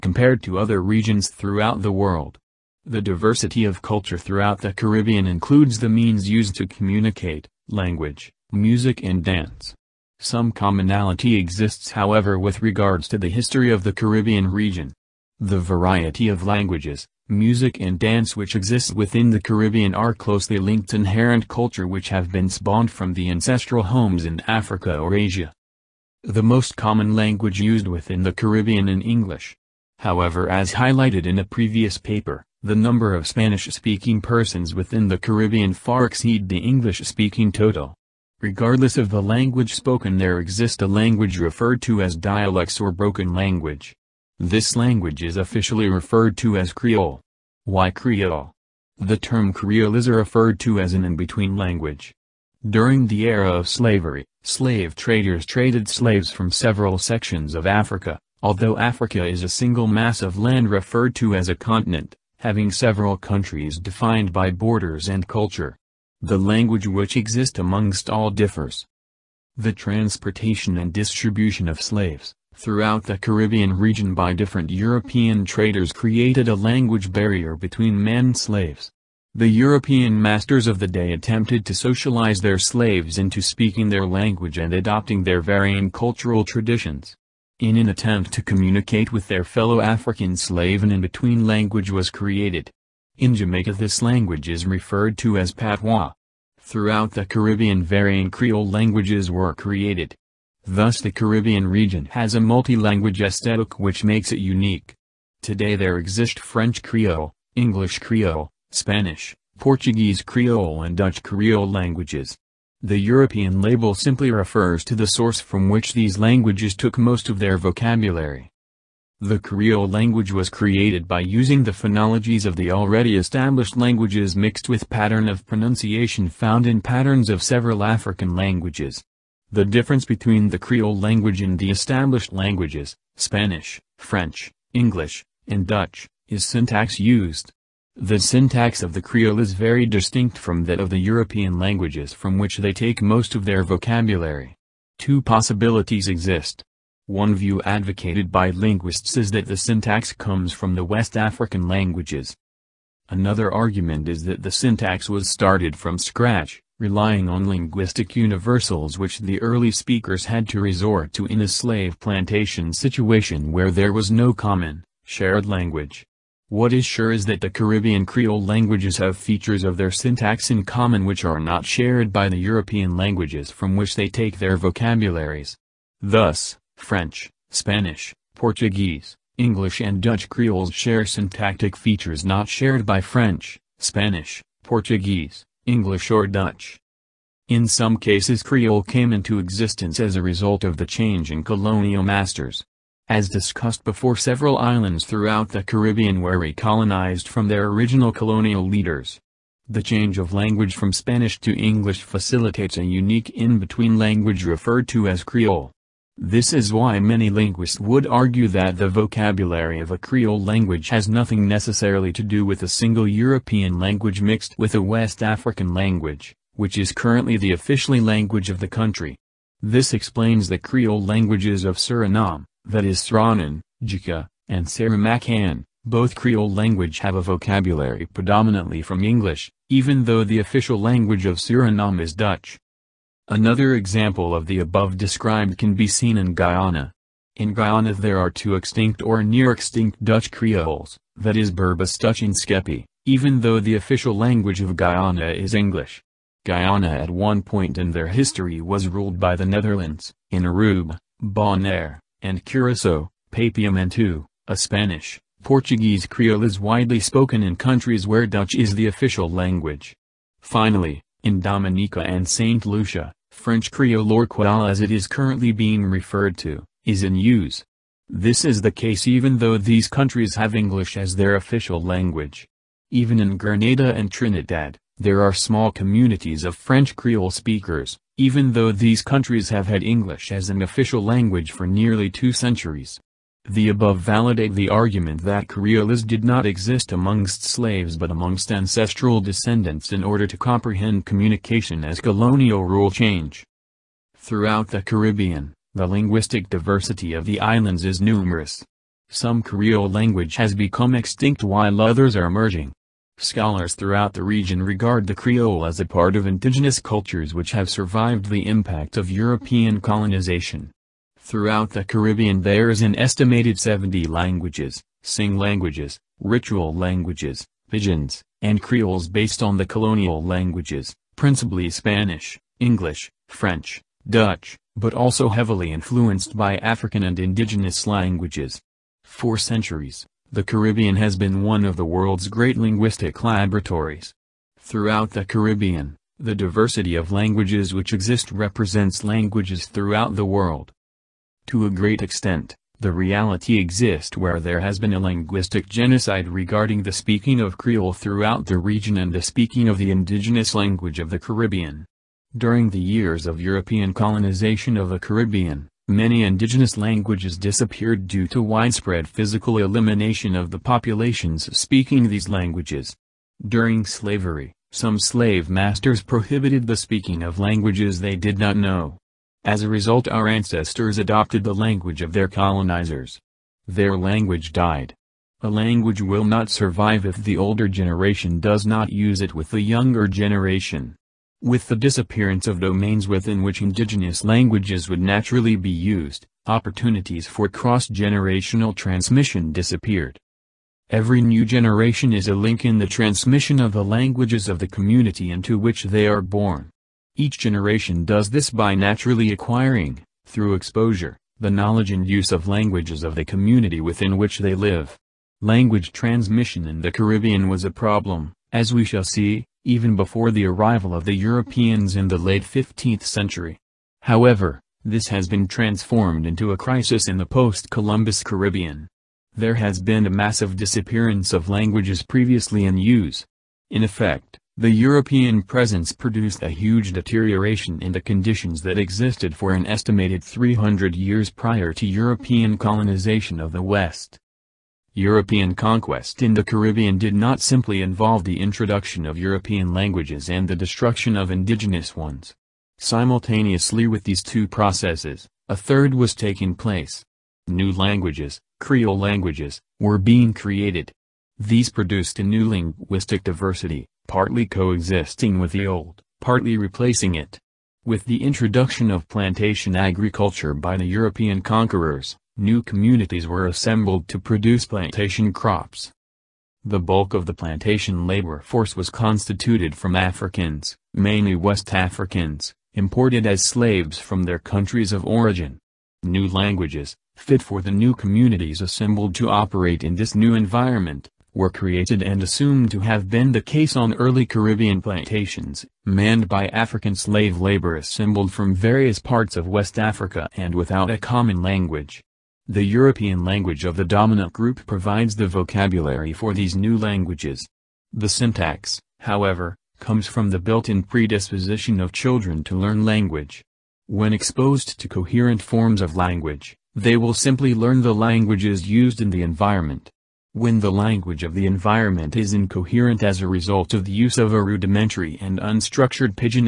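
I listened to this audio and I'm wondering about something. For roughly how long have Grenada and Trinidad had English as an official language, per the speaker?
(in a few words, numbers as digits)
nearly two centuries.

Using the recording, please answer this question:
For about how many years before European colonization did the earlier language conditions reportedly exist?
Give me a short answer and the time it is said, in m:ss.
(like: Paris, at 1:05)
300 years, at 7:10.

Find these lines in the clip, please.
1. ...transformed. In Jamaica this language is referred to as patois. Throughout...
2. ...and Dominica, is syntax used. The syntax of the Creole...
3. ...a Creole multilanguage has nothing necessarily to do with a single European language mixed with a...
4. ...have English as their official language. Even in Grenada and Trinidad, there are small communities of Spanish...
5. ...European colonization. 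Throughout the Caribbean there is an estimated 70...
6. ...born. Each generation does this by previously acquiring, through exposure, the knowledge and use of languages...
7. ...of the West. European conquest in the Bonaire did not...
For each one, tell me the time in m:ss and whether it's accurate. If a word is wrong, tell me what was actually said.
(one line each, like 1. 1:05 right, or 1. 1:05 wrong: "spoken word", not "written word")
1. 1:32 wrong: "created", not "transformed"
2. 2:15 wrong: "Dutch", not "Dominica"
3. 3:29 wrong: "language", not "multilanguage"
4. 4:30 wrong: "French", not "Spanish"
5. 5:09 right
6. 6:36 wrong: "naturally", not "previously"
7. 7:13 wrong: "Caribbean", not "Bonaire".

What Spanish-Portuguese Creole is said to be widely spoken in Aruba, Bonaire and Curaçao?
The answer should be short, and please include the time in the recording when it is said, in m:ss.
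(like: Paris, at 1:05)
Papiamentu, at 4:13.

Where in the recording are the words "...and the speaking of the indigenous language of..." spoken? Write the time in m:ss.
5:48.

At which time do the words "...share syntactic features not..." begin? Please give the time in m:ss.
3:00.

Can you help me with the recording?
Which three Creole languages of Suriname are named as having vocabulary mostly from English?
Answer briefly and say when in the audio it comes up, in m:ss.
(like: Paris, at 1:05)
Sranan, Jika, and Saramaccan, at 3:42.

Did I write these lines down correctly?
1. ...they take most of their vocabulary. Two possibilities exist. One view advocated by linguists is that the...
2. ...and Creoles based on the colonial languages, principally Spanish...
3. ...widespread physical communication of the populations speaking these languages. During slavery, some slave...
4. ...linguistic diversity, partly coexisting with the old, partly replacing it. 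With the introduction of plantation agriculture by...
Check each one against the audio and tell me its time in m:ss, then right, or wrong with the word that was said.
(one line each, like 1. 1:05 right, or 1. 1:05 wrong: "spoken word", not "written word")
1. 2:22 right
2. 5:18 right
3. 5:58 wrong: "elimination", not "communication"
4. 7:32 right.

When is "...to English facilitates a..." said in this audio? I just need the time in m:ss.
3:21.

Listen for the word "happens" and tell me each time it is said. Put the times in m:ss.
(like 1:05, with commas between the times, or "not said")
not said.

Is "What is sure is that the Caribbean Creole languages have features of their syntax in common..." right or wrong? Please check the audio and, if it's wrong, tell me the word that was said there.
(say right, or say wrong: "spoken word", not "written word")
right.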